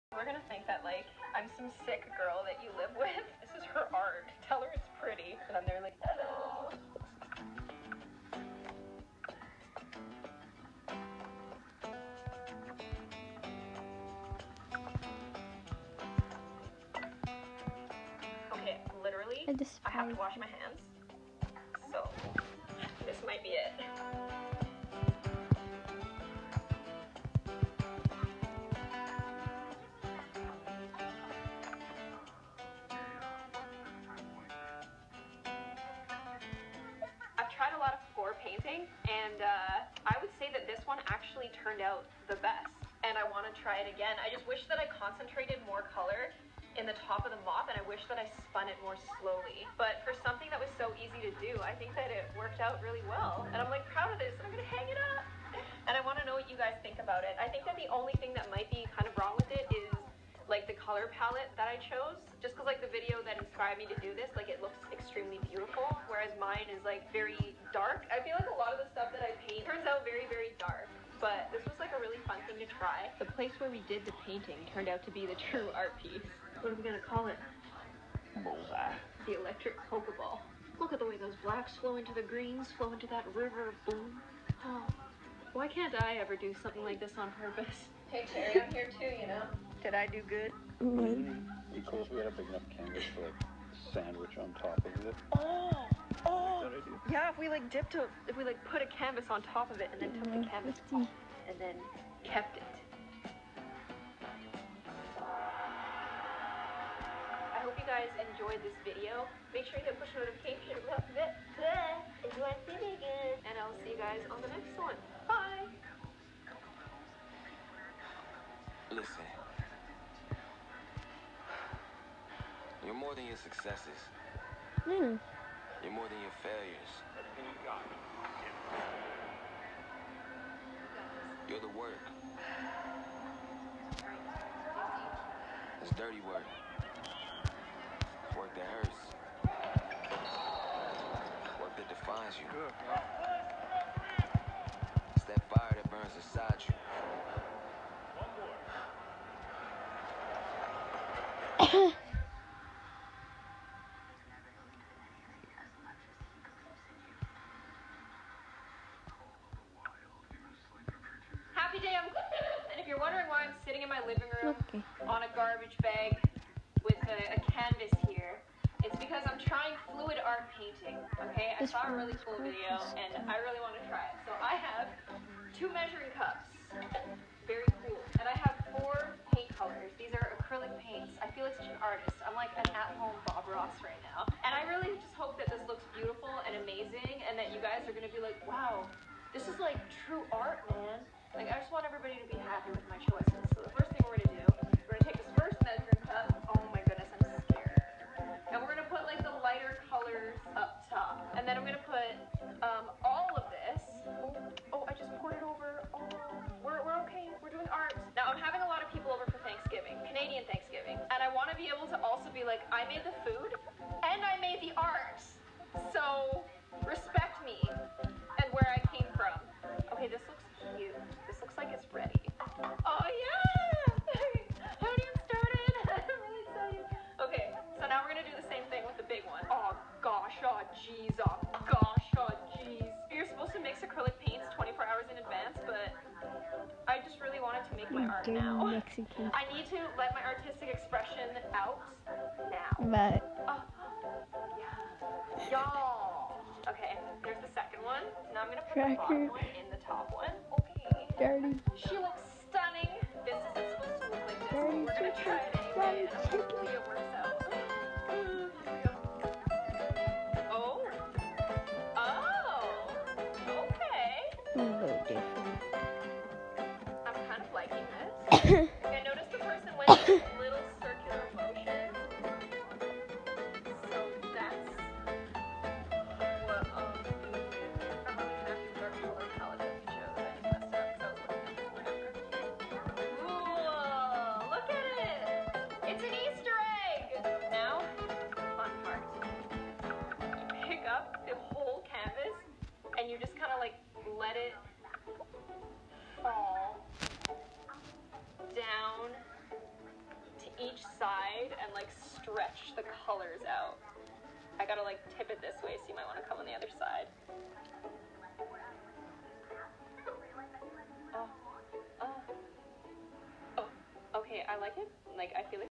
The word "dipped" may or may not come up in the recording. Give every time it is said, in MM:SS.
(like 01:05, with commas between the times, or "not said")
01:37.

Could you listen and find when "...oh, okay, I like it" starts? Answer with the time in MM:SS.
05:13.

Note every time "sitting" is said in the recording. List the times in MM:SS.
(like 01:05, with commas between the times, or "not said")
02:43.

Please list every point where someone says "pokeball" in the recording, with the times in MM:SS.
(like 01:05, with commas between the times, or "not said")
01:19.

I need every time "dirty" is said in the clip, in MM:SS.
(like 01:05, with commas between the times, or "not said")
02:15, 03:58, 04:11.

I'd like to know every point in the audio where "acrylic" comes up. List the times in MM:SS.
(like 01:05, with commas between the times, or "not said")
03:00, 03:53.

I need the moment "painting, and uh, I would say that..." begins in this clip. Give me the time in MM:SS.
00:38.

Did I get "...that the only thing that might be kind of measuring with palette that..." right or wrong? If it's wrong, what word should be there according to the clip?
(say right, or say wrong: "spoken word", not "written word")
wrong: "wrong", not "measuring".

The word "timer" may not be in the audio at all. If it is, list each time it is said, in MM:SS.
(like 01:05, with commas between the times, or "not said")
not said.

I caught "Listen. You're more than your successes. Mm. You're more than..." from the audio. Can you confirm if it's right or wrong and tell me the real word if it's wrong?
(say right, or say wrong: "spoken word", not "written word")
right.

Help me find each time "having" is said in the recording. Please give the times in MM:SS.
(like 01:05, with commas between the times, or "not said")
03:28.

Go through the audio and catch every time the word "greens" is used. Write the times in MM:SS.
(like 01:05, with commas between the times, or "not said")
01:22.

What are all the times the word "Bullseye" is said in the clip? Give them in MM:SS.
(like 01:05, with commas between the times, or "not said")
01:18.